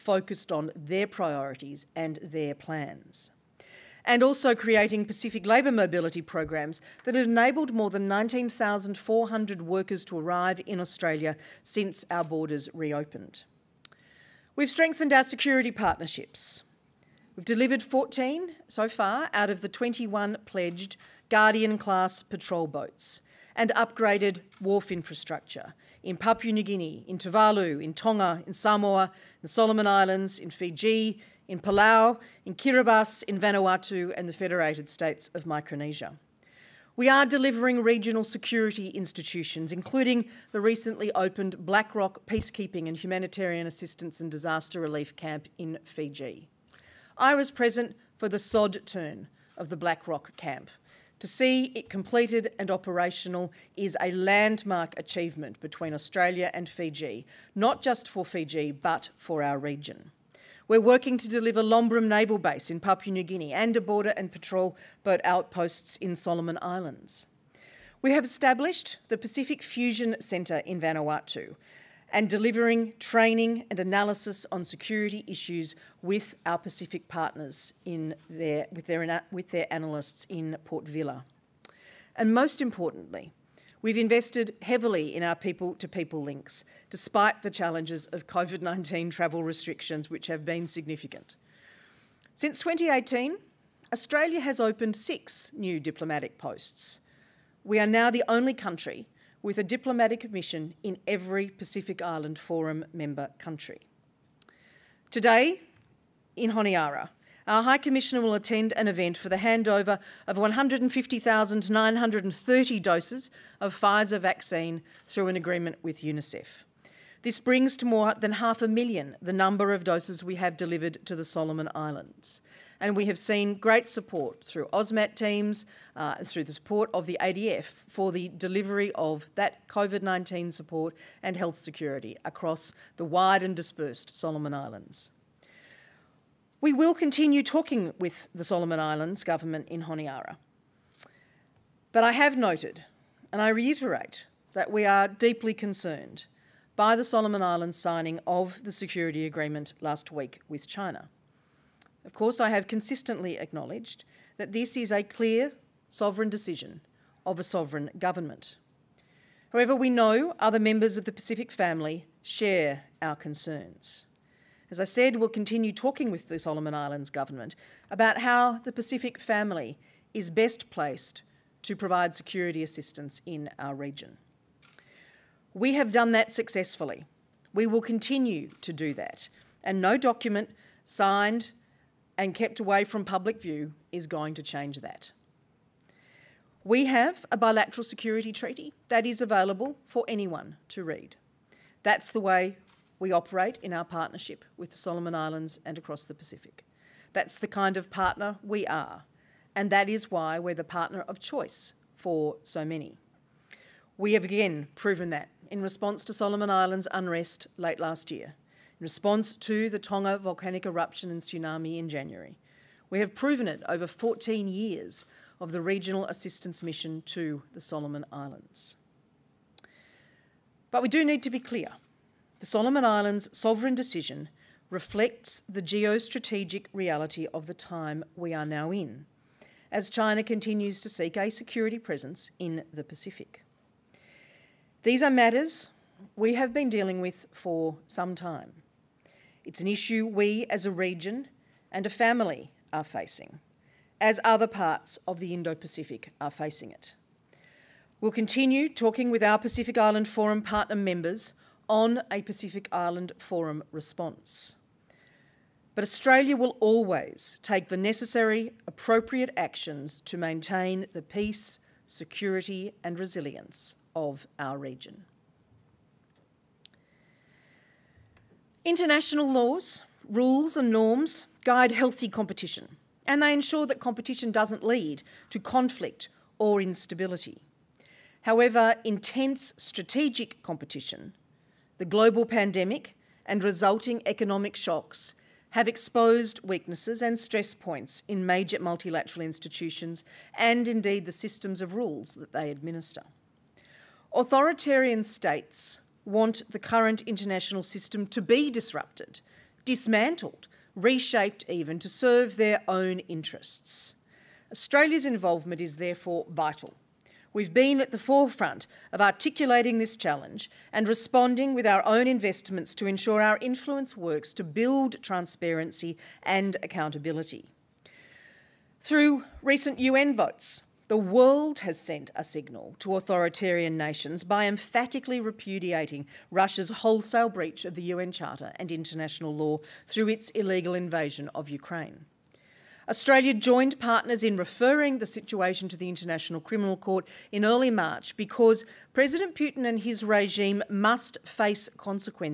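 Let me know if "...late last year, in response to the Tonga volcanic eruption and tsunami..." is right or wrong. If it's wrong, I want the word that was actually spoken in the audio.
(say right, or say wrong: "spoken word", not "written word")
right.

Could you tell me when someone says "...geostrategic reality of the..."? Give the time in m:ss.
3:45.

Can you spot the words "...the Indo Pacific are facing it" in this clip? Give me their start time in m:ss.
4:05.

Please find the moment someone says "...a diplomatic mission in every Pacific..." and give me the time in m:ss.
1:39.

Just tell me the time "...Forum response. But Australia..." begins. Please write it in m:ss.
4:13.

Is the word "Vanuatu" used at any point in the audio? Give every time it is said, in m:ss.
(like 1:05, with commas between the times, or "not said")
0:33, 1:10.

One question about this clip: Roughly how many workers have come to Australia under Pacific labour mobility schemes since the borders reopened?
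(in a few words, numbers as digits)
19,400.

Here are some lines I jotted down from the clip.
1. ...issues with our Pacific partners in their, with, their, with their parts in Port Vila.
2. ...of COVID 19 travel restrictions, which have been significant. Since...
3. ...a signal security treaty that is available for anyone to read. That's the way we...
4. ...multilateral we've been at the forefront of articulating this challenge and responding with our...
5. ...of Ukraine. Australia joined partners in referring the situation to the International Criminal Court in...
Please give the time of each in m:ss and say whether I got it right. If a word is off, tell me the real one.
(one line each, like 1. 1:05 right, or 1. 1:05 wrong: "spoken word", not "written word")
1. 1:15 wrong: "analysts", not "parts"
2. 1:28 right
3. 3:07 wrong: "bilateral", not "signal"
4. 5:06 wrong: "vital", not "multilateral"
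5. 5:31 right.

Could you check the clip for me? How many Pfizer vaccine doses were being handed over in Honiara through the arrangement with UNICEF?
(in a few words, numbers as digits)
150,930.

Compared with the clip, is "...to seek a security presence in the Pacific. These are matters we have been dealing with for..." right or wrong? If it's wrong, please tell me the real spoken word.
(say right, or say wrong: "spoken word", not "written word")
right.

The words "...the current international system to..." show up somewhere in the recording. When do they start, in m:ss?
4:56.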